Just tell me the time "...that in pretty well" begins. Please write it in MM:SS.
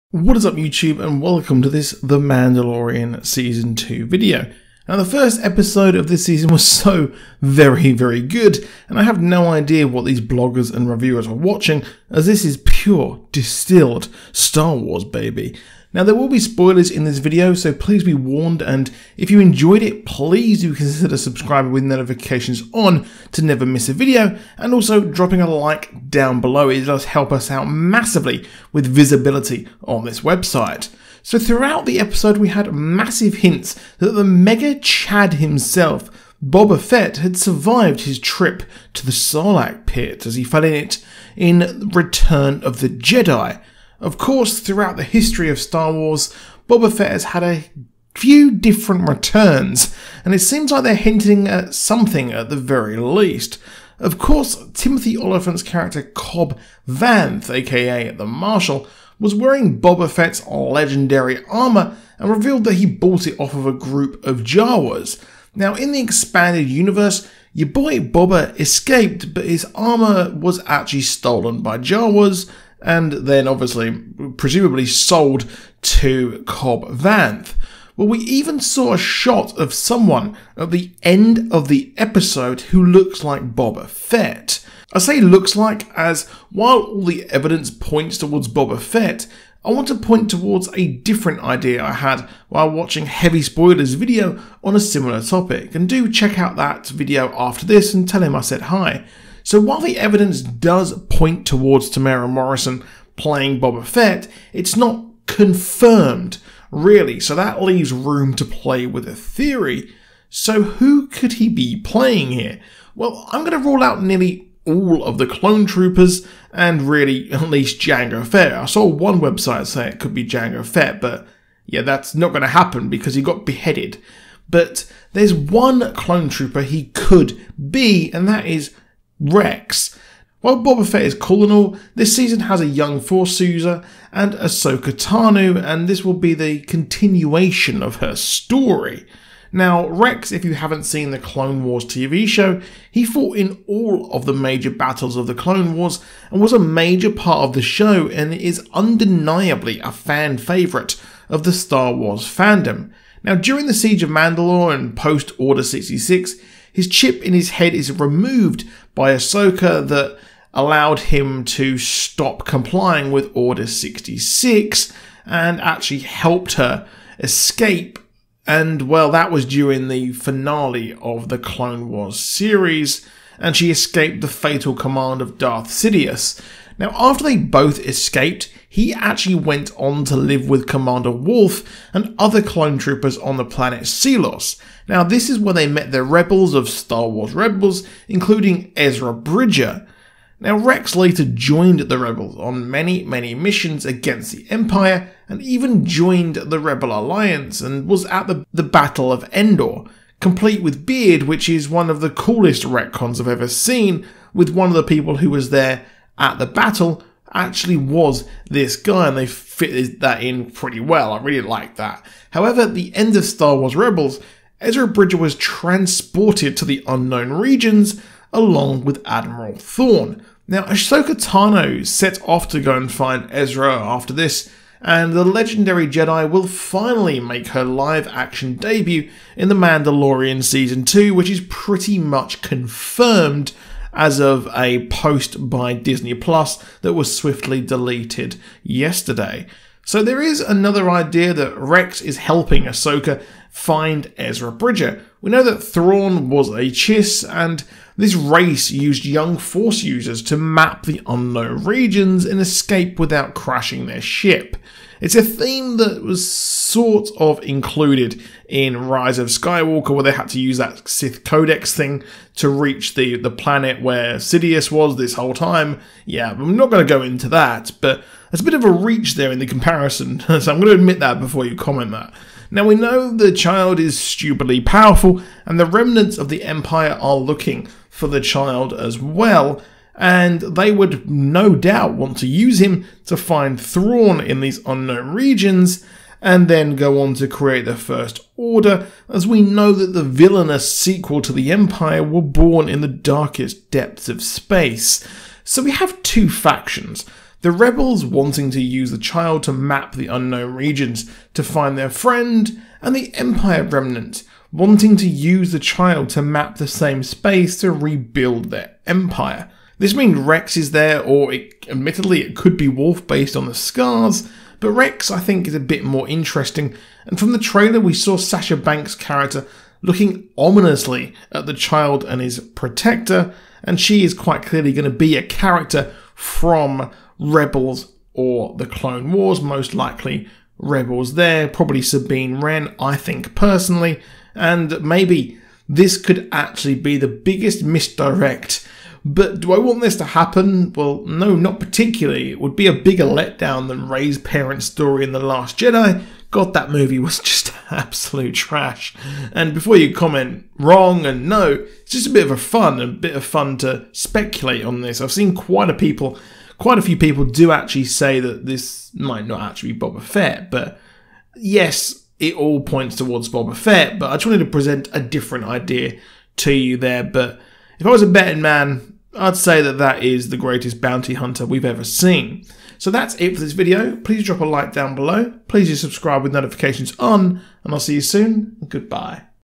03:30.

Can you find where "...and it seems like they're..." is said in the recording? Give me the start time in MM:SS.
00:50.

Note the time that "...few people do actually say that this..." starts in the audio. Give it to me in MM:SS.
05:56.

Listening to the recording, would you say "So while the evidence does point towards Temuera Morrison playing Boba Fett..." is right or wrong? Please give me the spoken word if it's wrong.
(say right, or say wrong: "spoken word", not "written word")
right.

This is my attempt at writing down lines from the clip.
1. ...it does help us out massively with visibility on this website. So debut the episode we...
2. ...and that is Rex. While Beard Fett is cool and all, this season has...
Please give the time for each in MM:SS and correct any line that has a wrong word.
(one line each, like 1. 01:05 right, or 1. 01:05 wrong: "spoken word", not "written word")
1. 00:26 wrong: "throughout", not "debut"
2. 02:08 wrong: "Boba", not "Beard".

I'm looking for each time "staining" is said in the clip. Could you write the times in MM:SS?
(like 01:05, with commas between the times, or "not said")
not said.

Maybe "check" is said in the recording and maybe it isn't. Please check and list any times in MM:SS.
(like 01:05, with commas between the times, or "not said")
01:36.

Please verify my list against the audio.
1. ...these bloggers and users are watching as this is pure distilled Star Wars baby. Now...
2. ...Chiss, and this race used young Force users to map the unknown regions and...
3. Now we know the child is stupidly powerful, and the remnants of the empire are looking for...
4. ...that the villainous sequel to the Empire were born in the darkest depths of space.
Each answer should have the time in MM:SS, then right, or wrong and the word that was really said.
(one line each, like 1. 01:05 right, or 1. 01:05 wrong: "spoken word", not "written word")
1. 00:10 wrong: "reviewers", not "users"
2. 04:06 right
3. 04:32 right
4. 04:49 right.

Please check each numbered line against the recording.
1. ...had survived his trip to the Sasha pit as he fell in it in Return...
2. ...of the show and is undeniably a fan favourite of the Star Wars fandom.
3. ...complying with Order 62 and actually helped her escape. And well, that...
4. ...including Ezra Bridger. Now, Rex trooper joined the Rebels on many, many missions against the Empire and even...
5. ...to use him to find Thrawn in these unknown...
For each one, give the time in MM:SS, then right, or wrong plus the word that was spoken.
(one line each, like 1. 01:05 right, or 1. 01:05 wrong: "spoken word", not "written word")
1. 00:37 wrong: "Sarlacc", not "Sasha"
2. 02:27 right
3. 02:42 wrong: "66", not "62"
4. 03:08 wrong: "later", not "trooper"
5. 04:42 right.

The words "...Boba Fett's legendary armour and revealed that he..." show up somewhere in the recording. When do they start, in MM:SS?
00:59.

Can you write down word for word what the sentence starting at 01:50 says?
So who could he be playing here?